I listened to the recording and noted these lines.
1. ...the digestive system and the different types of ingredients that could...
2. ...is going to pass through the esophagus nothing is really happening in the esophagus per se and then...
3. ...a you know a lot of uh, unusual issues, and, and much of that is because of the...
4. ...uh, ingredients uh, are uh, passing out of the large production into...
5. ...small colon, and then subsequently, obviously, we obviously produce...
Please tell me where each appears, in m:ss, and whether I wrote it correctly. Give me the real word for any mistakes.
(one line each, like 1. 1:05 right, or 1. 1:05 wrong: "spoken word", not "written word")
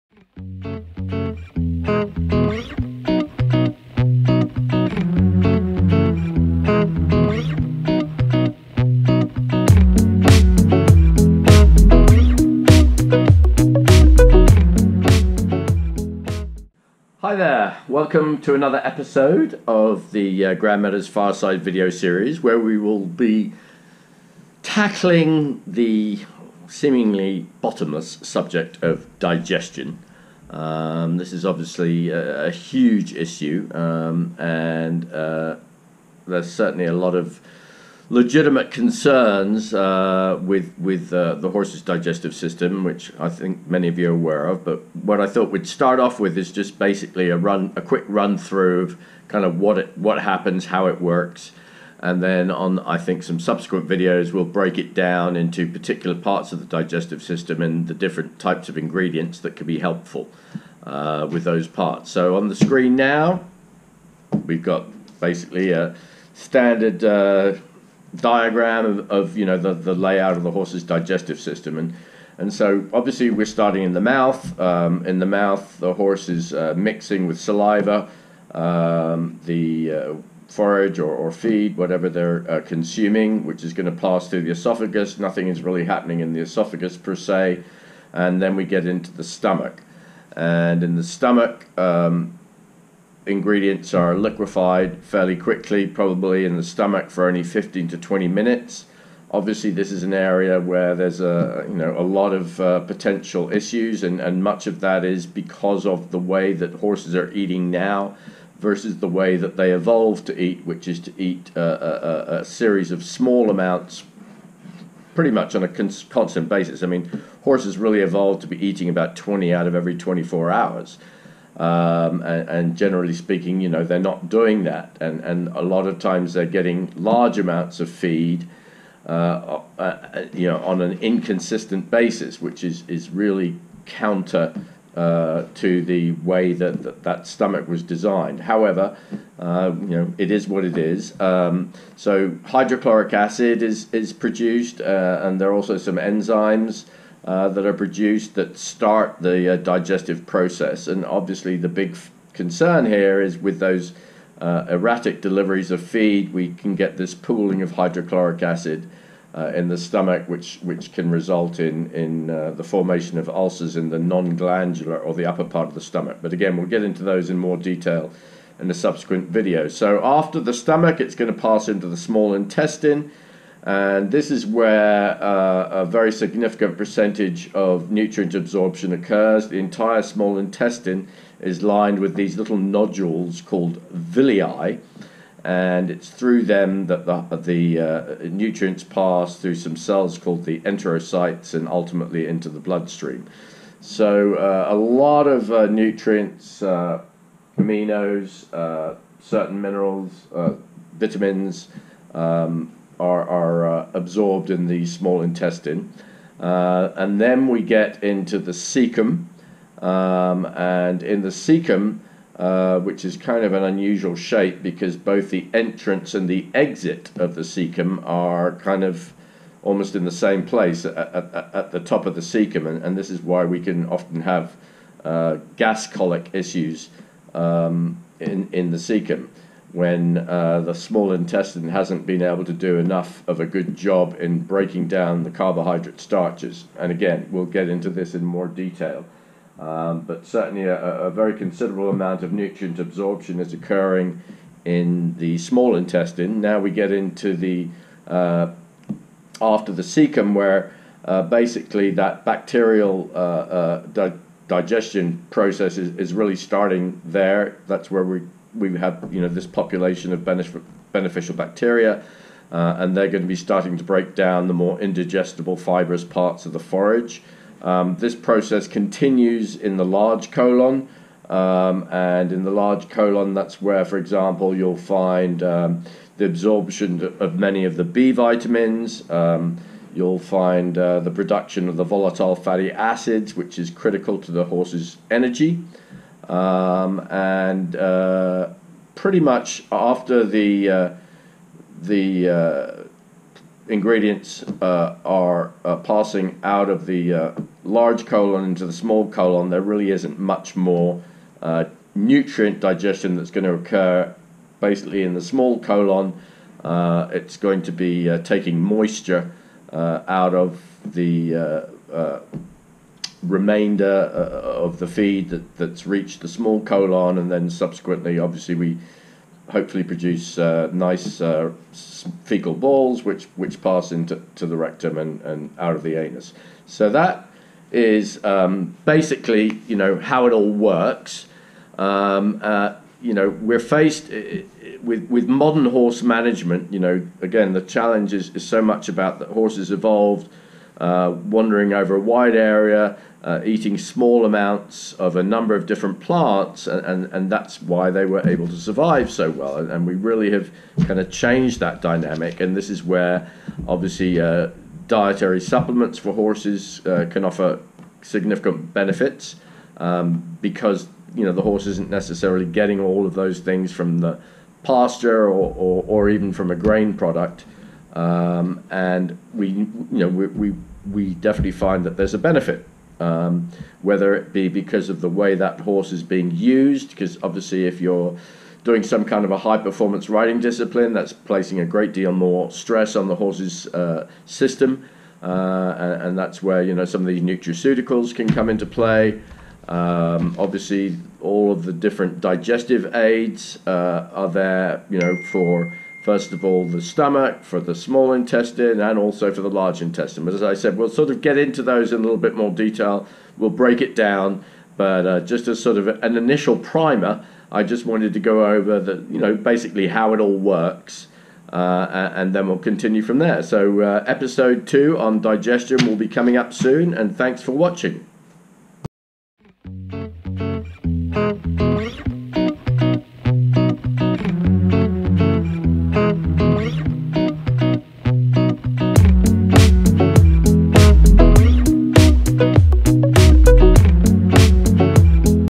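1. 0:56 right
2. 1:23 right
3. 1:41 wrong: "potential", not "unusual"
4. 4:52 wrong: "colon", not "production"
5. 5:16 wrong: "hopefully", not "obviously".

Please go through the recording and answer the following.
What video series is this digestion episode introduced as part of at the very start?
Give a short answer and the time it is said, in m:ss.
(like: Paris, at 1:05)
Grand Meadows Fireside, at 0:20.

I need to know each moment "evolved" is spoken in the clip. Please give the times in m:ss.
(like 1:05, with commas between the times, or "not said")
1:49, 1:58, 5:39.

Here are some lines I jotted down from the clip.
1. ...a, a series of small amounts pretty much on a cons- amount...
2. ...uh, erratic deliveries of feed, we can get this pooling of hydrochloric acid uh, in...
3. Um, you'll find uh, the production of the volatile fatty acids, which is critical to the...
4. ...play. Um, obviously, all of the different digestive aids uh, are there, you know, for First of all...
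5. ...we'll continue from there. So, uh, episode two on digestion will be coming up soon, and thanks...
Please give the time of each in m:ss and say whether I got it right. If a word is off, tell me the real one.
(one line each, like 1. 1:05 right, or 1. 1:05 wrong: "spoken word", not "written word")
1. 1:51 wrong: "constant", not "amount"
2. 2:34 right
3. 4:39 right
4. 6:28 right
5. 6:52 right.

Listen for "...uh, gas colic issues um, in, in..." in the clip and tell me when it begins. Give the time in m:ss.
3:45.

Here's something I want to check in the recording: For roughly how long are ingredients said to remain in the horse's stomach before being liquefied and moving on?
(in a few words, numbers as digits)
15 to 20 minutes.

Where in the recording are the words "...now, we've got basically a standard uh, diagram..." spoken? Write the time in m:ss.
1:02.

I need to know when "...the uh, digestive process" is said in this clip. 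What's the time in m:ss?
2:29.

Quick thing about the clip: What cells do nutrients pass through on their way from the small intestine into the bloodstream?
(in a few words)
enterocytes.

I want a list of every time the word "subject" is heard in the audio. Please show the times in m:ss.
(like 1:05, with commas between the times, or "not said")
0:28.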